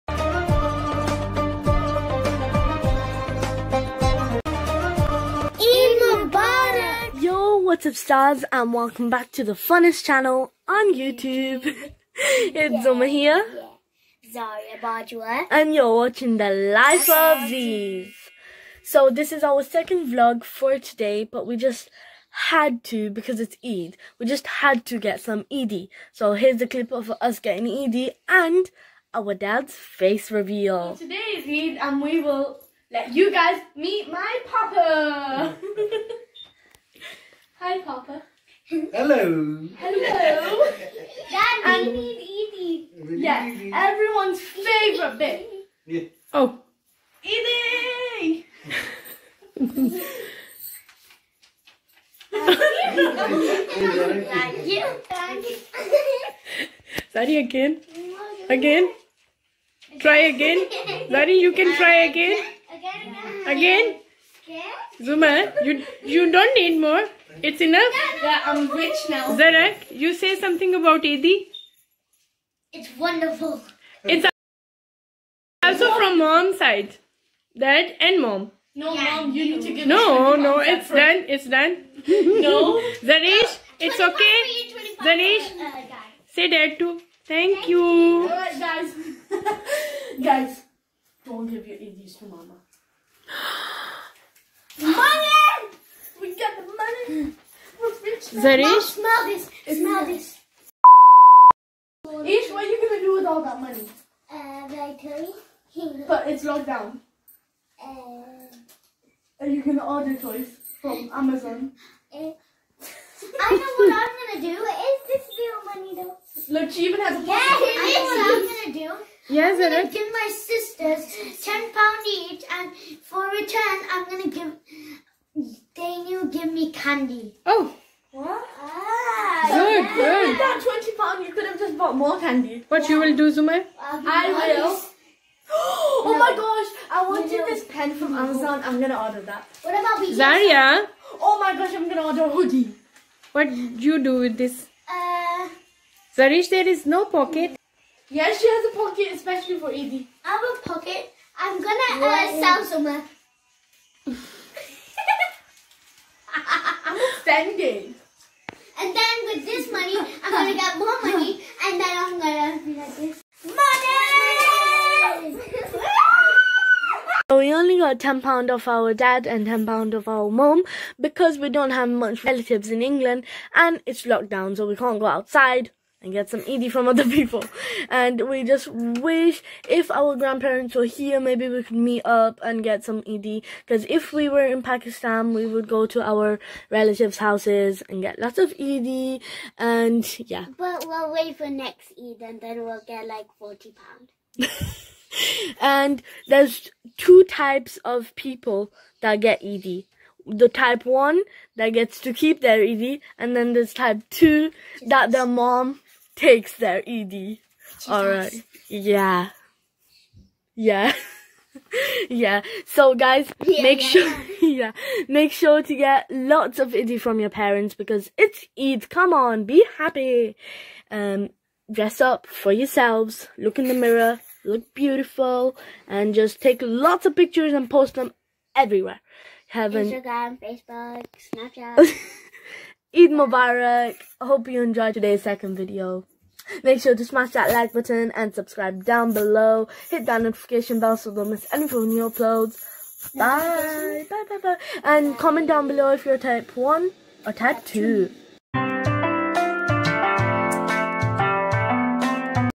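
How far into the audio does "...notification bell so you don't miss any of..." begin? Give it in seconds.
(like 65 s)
240 s.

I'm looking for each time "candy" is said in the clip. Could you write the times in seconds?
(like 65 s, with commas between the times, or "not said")
126 s, 132 s.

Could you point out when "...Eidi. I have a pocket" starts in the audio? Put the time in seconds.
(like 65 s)
149 s.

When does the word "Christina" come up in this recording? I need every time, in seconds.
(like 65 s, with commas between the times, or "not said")
not said.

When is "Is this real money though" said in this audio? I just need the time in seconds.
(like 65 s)
114 s.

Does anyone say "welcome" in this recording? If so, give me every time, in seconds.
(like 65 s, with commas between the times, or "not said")
8 s.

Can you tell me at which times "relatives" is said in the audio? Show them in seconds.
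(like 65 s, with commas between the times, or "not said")
172 s, 186 s.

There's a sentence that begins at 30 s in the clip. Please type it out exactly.
So today is Eid and we will let you guys meet my papa.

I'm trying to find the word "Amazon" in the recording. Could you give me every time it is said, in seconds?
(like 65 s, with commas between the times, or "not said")
111 s, 138 s.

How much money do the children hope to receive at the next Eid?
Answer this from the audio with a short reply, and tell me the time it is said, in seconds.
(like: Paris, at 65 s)
40 pounds, at 193 s.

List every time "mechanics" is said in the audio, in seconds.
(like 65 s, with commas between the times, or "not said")
not said.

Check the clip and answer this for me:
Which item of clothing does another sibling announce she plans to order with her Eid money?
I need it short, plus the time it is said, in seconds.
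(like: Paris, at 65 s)
hoodie, at 142 s.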